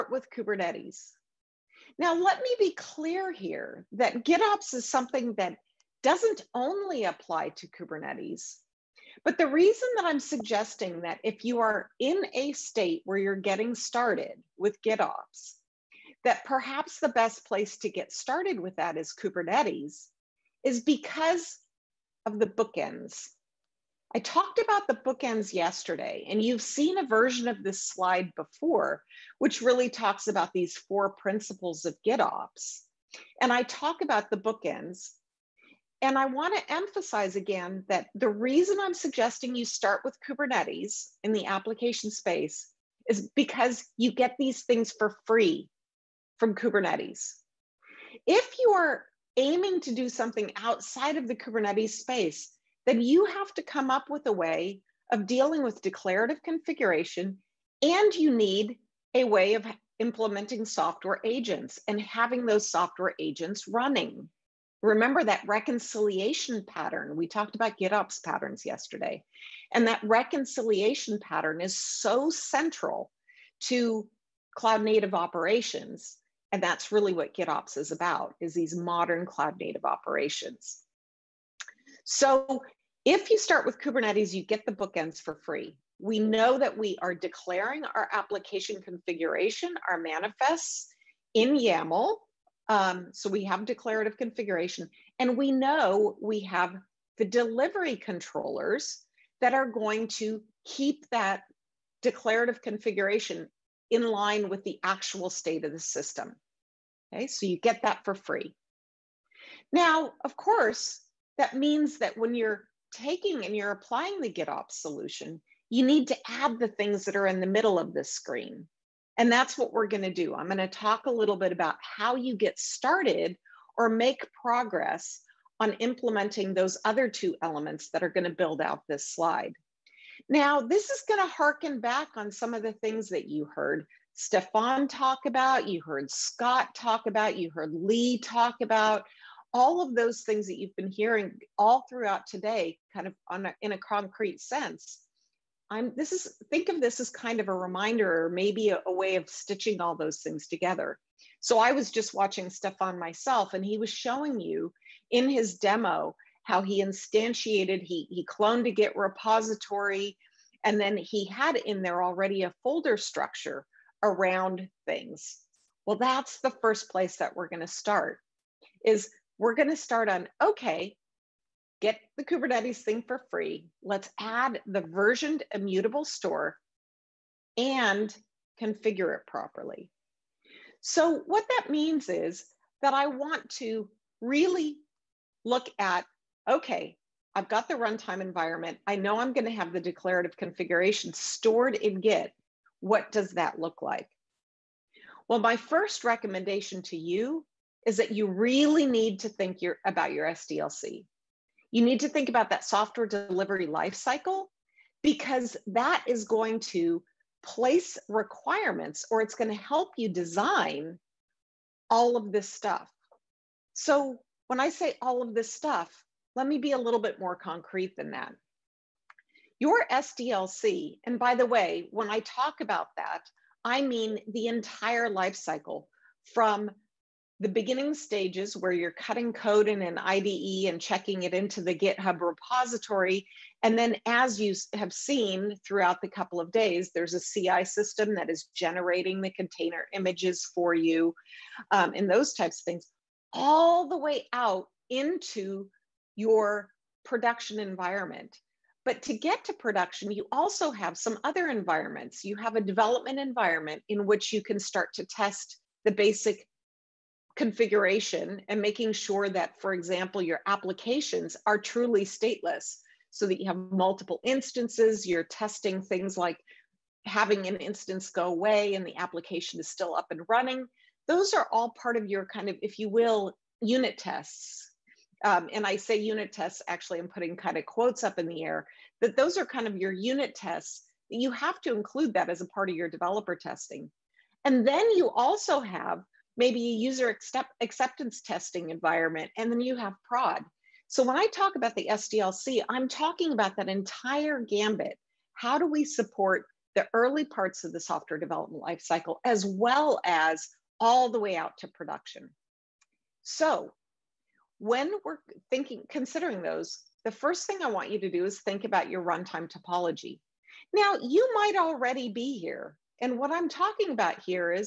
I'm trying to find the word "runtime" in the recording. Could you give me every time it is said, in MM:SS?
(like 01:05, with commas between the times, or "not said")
03:07, 05:09.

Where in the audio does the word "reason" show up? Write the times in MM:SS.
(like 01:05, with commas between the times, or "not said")
00:09, 00:38.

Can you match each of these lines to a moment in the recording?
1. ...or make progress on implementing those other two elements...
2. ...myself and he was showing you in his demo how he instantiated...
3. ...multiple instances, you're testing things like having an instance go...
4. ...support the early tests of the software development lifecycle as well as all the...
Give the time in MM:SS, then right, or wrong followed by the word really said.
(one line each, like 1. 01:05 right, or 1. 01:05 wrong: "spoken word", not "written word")
1. 02:03 right
2. 02:32 right
3. 04:23 right
4. 04:55 wrong: "parts", not "tests".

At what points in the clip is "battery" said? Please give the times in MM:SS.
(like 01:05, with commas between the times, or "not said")
not said.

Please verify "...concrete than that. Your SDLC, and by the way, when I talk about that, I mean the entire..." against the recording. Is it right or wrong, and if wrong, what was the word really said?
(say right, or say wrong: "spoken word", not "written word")
right.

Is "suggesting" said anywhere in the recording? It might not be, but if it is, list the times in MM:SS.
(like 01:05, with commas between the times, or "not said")
00:10, 00:38.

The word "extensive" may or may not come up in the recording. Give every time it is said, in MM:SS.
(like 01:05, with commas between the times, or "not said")
not said.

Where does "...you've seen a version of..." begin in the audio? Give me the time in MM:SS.
00:26.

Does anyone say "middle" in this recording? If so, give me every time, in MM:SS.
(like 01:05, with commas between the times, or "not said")
01:57.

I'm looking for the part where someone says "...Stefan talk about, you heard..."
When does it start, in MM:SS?
02:14.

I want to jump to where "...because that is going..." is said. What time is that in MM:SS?
03:25.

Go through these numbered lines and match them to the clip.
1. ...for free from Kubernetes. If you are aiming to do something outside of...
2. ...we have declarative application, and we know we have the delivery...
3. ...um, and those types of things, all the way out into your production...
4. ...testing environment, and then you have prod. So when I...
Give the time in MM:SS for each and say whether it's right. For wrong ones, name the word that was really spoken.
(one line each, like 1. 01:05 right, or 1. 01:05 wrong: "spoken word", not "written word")
1. 00:44 right
2. 01:33 wrong: "configuration", not "application"
3. 04:01 right
4. 04:48 right.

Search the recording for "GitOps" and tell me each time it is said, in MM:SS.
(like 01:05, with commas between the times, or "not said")
00:04, 00:14, 00:32, 01:07, 01:17, 01:54.